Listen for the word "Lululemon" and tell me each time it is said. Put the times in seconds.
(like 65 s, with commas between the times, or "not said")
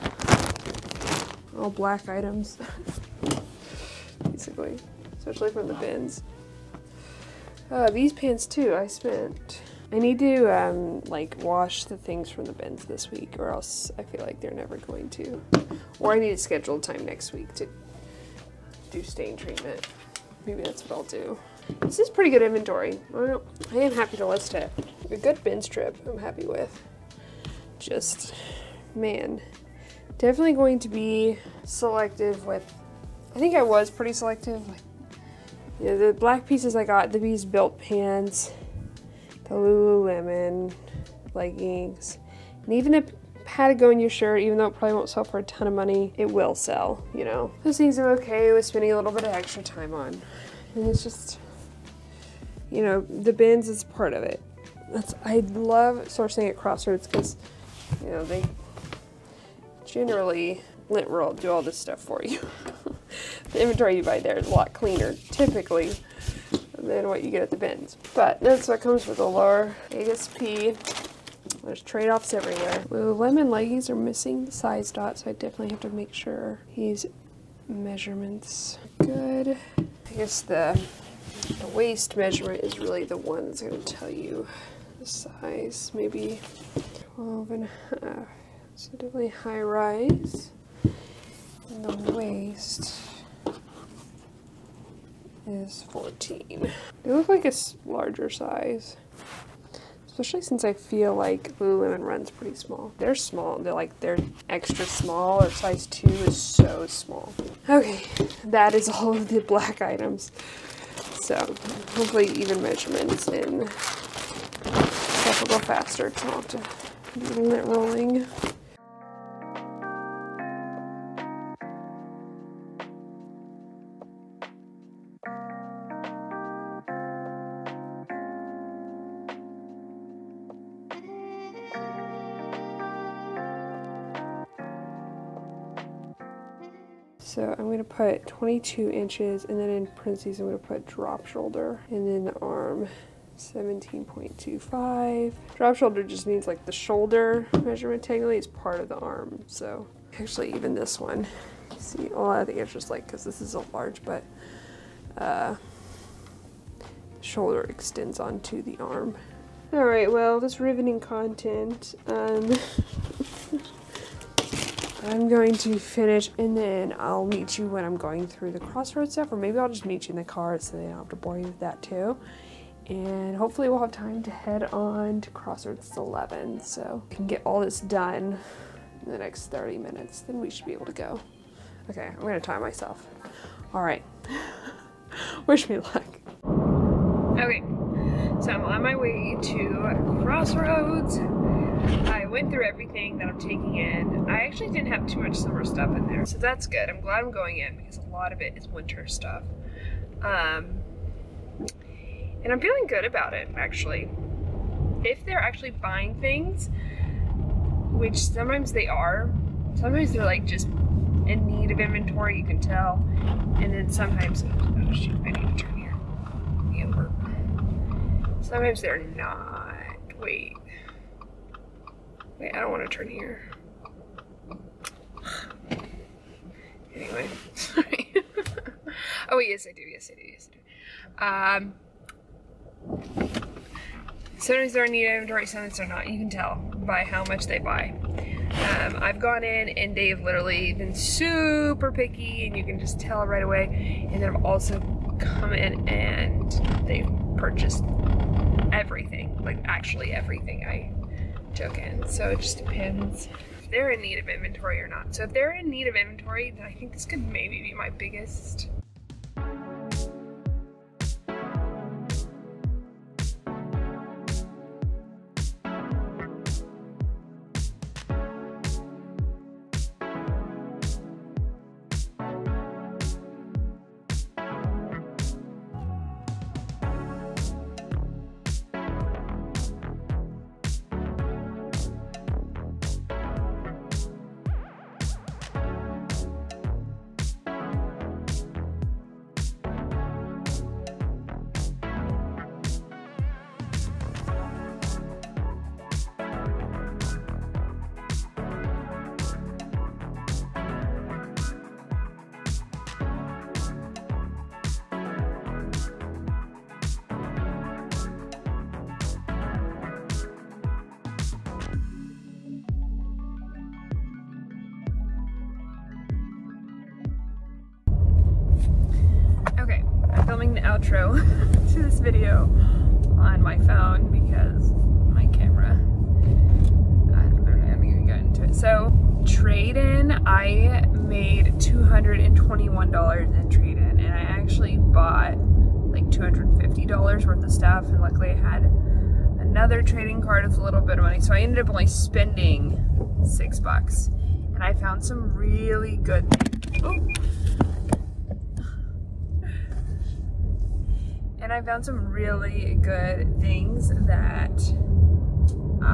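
39 s, 101 s.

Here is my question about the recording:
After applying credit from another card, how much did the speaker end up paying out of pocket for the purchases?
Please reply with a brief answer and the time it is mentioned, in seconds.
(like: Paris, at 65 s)
$6, at 343 s.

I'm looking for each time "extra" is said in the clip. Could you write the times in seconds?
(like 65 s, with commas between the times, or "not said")
49 s, 104 s.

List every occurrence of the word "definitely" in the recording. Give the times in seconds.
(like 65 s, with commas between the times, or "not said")
30 s, 75 s.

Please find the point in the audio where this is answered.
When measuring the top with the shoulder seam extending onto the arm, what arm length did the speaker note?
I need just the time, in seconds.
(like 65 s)
143 s.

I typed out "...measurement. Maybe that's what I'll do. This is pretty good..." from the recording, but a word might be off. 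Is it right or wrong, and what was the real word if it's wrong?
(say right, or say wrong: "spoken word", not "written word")
wrong: "treatment", not "measurement".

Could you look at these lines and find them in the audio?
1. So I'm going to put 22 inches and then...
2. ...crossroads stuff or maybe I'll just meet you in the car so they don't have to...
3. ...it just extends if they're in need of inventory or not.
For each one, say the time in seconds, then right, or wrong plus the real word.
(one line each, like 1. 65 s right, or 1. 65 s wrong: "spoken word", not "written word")
1. 137 s right
2. 168 s right
3. 252 s wrong: "depends", not "extends".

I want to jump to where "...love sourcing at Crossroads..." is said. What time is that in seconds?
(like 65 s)
55 s.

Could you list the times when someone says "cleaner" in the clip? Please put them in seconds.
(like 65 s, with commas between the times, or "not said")
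64 s.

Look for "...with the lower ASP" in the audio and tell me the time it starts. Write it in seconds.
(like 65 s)
69 s.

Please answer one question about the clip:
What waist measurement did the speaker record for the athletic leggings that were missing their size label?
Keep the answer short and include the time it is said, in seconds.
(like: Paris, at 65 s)
14, at 95 s.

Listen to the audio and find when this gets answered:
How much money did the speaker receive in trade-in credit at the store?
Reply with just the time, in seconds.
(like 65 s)
331 s.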